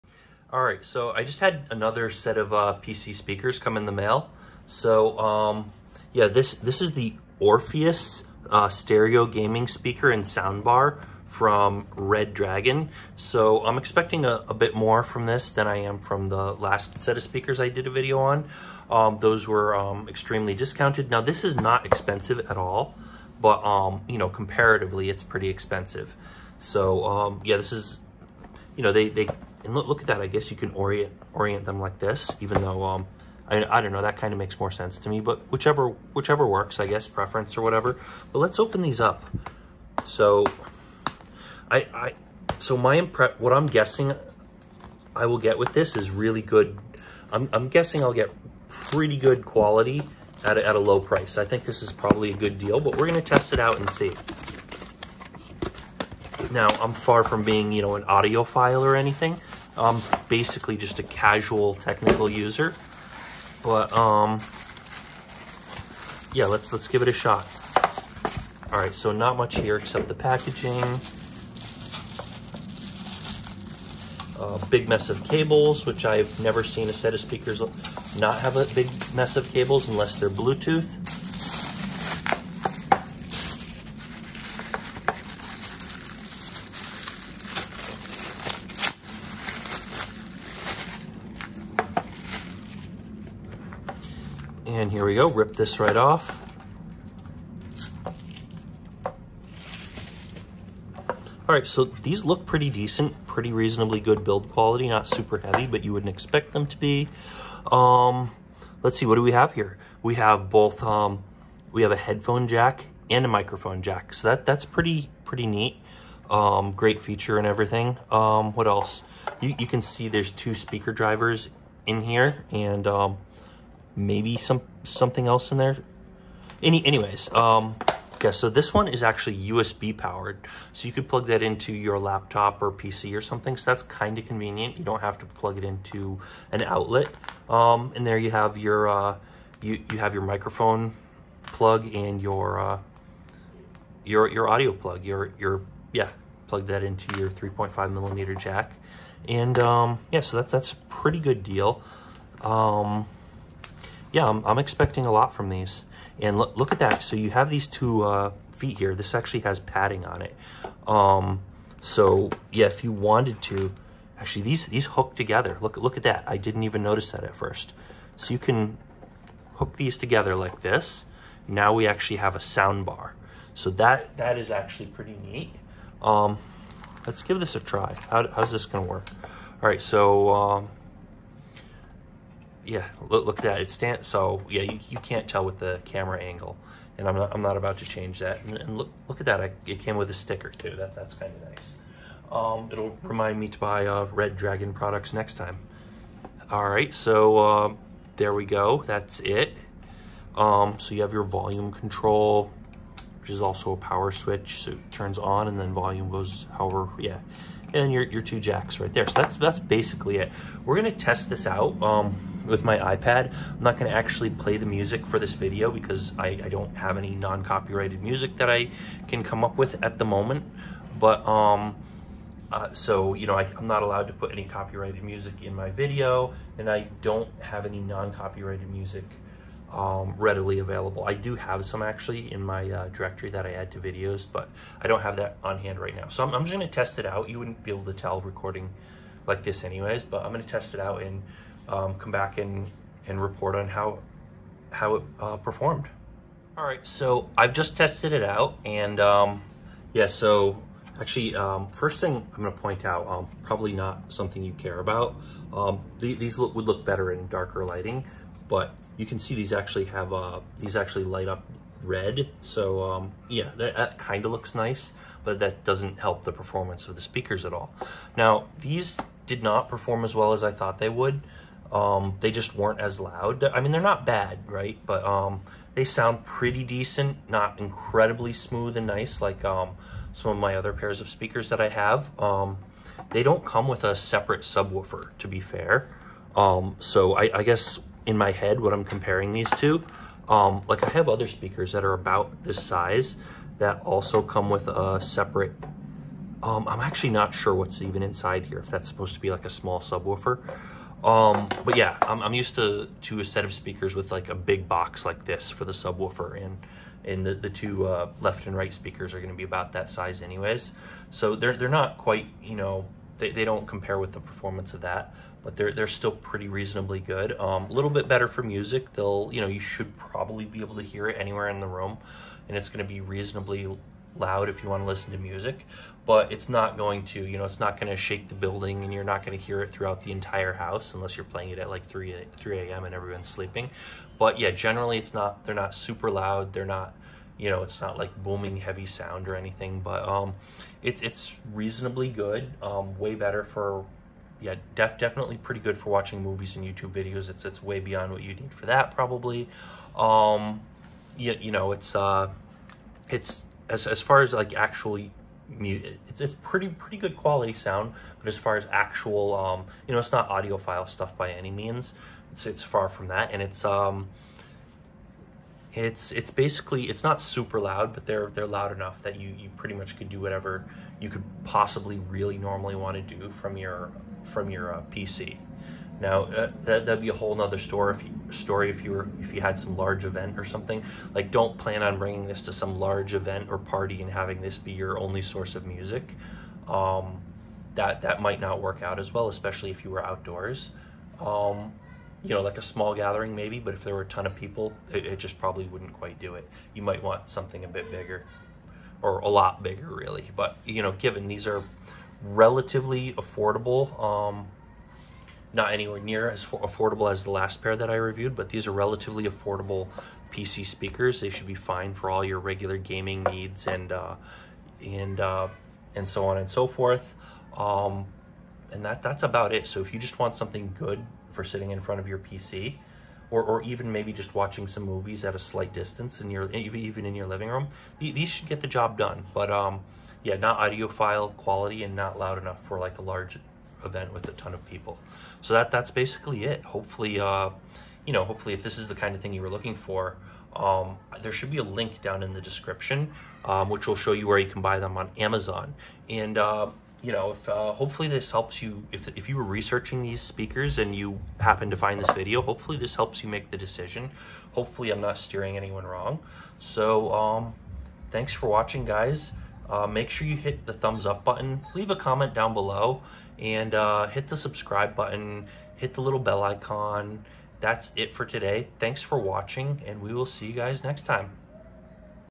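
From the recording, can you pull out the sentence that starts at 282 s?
Um, they don't come with a separate subwoofer, to be fair.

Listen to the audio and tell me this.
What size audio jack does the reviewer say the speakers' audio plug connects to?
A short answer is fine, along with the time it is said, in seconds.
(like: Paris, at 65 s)
3.5 millimeter, at 147 s.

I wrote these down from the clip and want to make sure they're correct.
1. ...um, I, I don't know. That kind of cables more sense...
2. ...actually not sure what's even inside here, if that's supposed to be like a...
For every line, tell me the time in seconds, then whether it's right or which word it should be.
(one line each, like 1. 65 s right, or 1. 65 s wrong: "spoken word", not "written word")
1. 32 s wrong: "makes", not "cables"
2. 296 s right.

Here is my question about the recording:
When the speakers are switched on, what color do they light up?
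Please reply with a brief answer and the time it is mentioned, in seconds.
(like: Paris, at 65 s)
Red, at 261 s.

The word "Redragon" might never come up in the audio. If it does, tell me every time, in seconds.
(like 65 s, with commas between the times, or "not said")
11 s, 194 s.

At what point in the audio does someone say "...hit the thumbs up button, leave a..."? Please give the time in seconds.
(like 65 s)
460 s.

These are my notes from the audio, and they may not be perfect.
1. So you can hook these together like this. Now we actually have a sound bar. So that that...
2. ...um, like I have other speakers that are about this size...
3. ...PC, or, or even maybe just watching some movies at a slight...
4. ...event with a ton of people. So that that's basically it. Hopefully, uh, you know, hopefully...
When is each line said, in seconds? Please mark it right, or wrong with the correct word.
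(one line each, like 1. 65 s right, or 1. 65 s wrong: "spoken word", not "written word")
1. 168 s right
2. 290 s right
3. 422 s right
4. 433 s right.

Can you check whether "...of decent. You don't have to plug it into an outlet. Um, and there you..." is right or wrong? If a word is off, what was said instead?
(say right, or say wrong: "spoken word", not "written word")
wrong: "convenient", not "decent".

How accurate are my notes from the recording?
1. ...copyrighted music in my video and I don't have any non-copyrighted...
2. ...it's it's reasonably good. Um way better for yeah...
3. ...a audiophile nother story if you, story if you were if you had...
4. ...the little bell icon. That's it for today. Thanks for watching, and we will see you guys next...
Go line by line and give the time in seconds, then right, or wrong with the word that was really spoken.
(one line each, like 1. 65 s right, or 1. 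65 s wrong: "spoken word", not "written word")
1. 224 s right
2. 340 s right
3. 377 s wrong: "whole", not "audiophile"
4. 465 s right.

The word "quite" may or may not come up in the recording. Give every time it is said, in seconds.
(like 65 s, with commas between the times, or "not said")
311 s, 395 s.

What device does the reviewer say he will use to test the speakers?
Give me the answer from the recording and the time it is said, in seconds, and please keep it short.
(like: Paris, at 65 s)
iPad, at 212 s.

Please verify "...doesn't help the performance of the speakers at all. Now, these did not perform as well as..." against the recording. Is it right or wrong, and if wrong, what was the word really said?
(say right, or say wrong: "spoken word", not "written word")
right.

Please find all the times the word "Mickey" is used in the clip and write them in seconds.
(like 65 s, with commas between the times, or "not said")
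not said.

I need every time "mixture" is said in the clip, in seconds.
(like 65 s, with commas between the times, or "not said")
not said.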